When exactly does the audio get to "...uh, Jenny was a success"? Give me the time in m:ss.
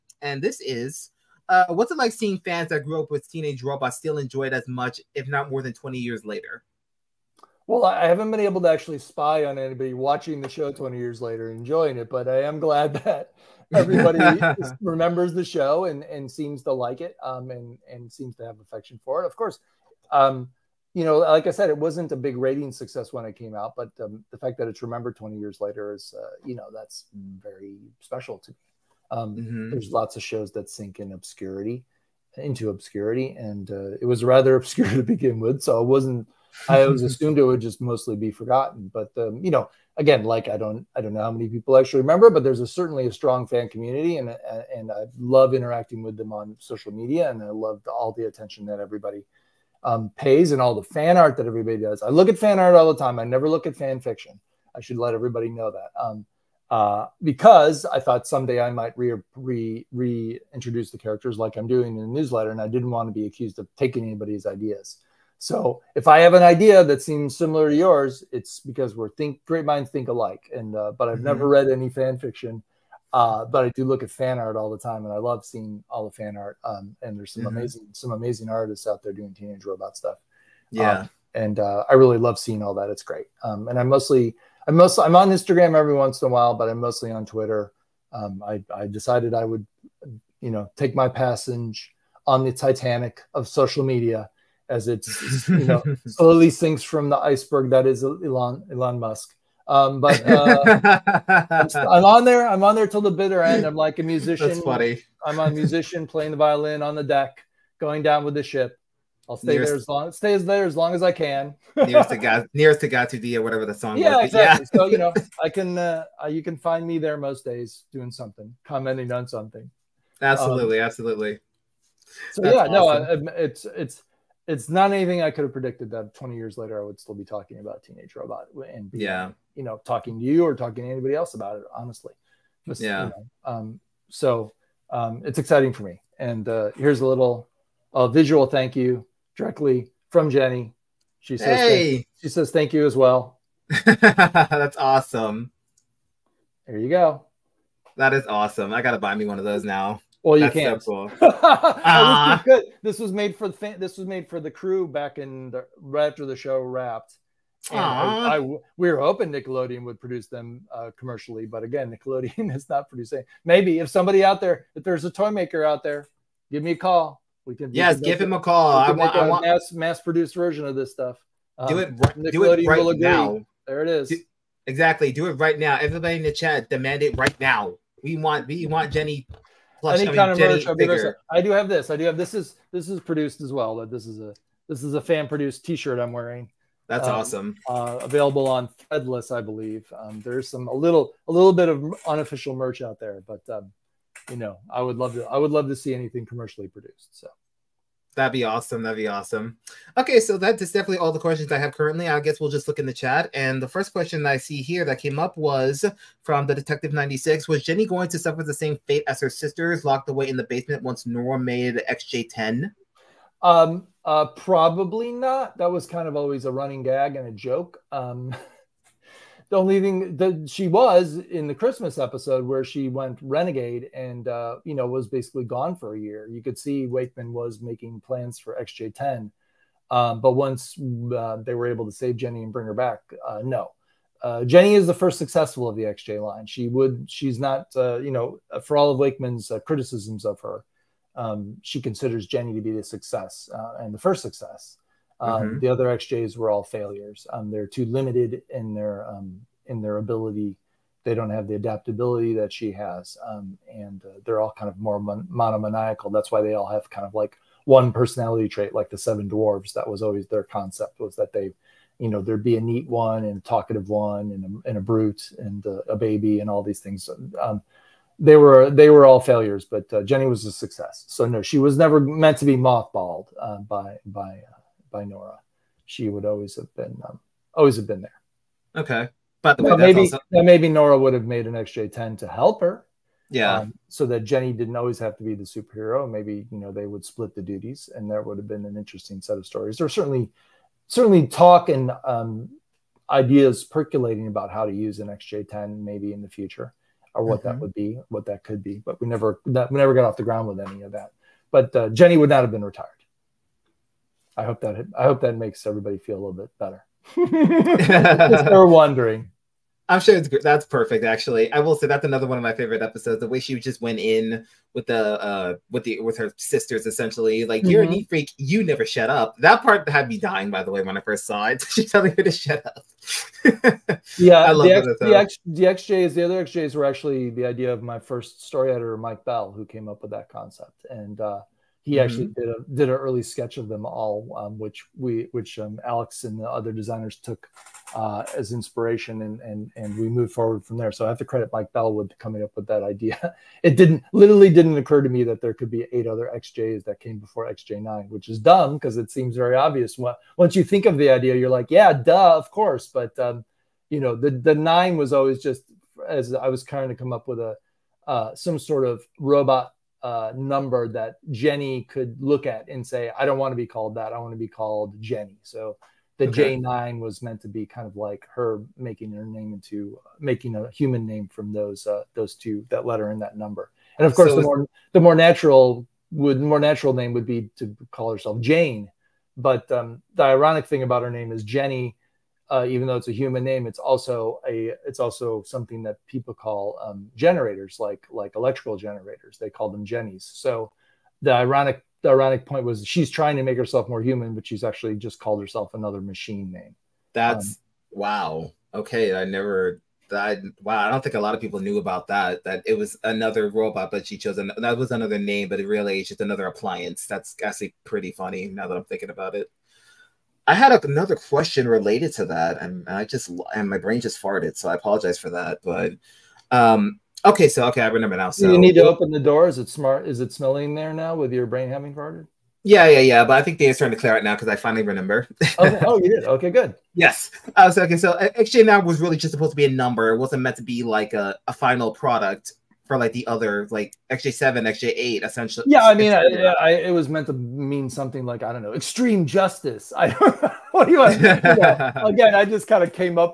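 4:29.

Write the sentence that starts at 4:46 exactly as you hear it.
Maybe you know they would split the duties, and there would have been an interesting set of stories.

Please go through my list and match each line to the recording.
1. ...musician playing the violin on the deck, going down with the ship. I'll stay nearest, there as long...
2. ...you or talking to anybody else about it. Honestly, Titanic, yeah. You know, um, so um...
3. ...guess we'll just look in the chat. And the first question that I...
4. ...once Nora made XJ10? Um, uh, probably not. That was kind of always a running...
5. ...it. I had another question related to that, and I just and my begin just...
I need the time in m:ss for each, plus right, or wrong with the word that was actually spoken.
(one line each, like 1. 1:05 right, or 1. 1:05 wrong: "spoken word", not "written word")
1. 1:45 right
2. 2:10 wrong: "Just", not "Titanic"
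3. 3:22 right
4. 3:30 right
5. 6:49 wrong: "brain", not "begin".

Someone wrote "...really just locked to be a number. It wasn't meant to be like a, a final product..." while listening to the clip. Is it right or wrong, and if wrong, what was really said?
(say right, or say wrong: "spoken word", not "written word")
wrong: "supposed", not "locked".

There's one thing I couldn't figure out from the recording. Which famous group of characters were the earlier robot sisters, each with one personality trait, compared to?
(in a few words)
the Seven Dwarves.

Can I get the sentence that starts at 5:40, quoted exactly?
So I have to credit Mike Bellwood coming up with that idea.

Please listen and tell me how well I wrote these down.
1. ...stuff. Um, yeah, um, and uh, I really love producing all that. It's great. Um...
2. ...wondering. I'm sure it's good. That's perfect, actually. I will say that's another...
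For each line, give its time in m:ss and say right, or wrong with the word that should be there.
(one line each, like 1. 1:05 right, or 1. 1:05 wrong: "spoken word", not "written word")
1. 1:19 wrong: "seeing", not "producing"
2. 5:08 right.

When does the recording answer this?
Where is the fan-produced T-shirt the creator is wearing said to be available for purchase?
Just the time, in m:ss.
3:08.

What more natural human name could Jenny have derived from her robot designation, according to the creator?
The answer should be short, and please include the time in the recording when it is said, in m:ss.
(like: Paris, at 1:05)
Jane, at 6:18.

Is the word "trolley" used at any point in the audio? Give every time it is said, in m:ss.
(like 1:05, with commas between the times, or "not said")
not said.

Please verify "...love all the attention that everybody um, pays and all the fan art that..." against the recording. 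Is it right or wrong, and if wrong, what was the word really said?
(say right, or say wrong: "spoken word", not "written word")
right.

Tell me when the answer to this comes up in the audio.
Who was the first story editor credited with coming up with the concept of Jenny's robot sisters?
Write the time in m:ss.
5:28.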